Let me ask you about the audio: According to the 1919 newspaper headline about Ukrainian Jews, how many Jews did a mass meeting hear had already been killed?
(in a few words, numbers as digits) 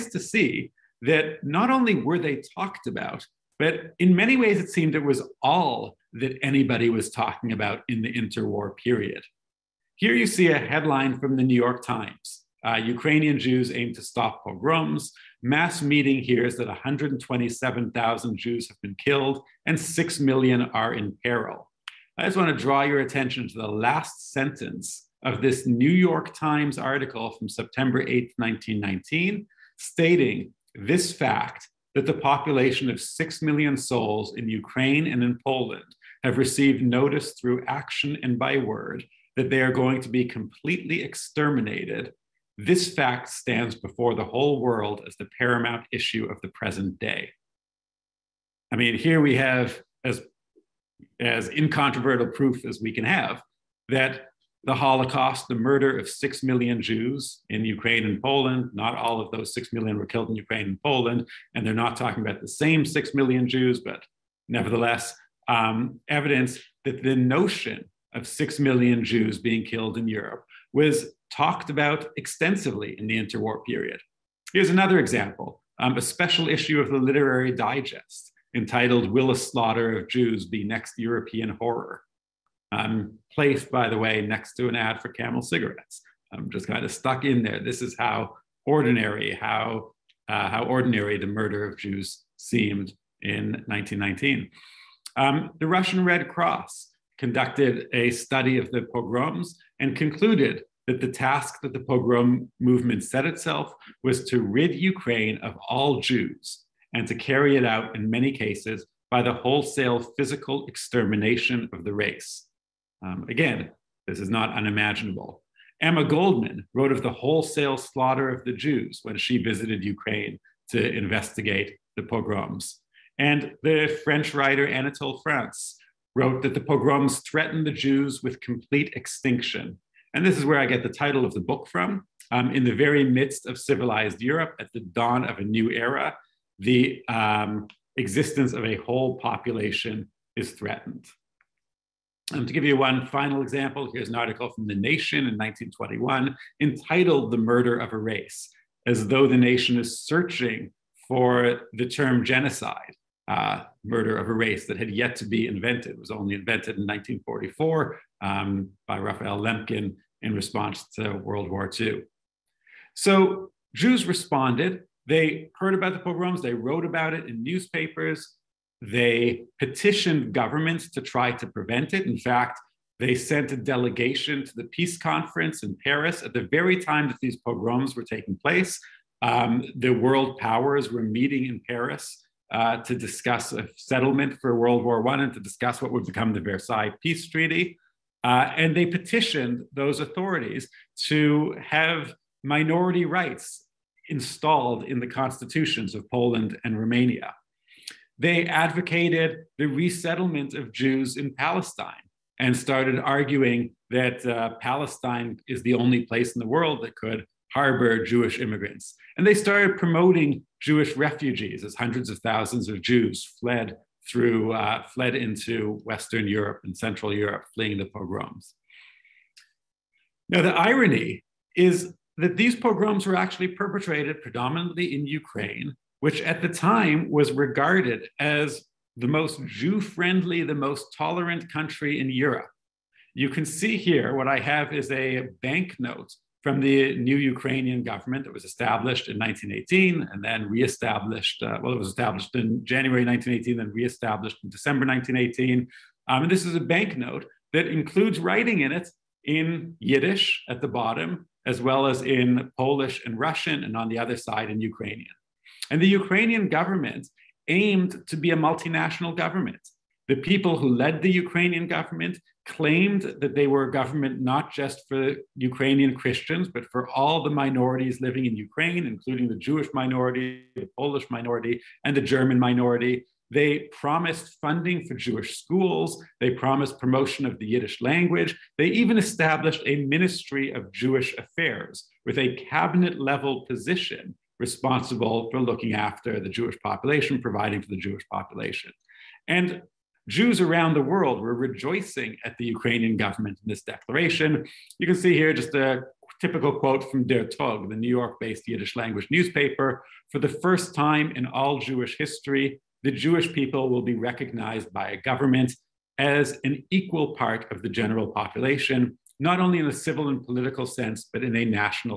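127,000.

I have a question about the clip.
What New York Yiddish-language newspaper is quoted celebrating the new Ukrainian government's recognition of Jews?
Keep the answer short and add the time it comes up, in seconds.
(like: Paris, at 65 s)
Der Tog, at 297 s.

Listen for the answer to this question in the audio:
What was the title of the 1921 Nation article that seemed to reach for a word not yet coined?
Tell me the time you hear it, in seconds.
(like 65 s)
147 s.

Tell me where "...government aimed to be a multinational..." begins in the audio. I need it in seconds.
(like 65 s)
256 s.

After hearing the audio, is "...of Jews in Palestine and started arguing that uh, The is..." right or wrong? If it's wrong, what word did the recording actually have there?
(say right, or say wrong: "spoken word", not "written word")
wrong: "Palestine", not "The".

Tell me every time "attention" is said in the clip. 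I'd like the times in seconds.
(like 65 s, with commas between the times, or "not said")
22 s.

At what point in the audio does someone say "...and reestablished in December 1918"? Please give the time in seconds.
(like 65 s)
243 s.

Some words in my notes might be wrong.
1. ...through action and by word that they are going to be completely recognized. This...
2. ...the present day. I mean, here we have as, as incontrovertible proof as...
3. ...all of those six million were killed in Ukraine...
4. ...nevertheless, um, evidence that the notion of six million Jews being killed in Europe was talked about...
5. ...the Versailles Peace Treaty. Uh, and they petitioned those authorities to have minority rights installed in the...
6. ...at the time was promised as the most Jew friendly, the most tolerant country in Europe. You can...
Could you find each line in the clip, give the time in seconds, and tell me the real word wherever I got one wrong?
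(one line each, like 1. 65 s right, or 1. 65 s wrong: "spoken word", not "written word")
1. 37 s wrong: "exterminated", not "recognized"
2. 46 s right
3. 58 s right
4. 64 s right
5. 186 s right
6. 226 s wrong: "regarded", not "promised".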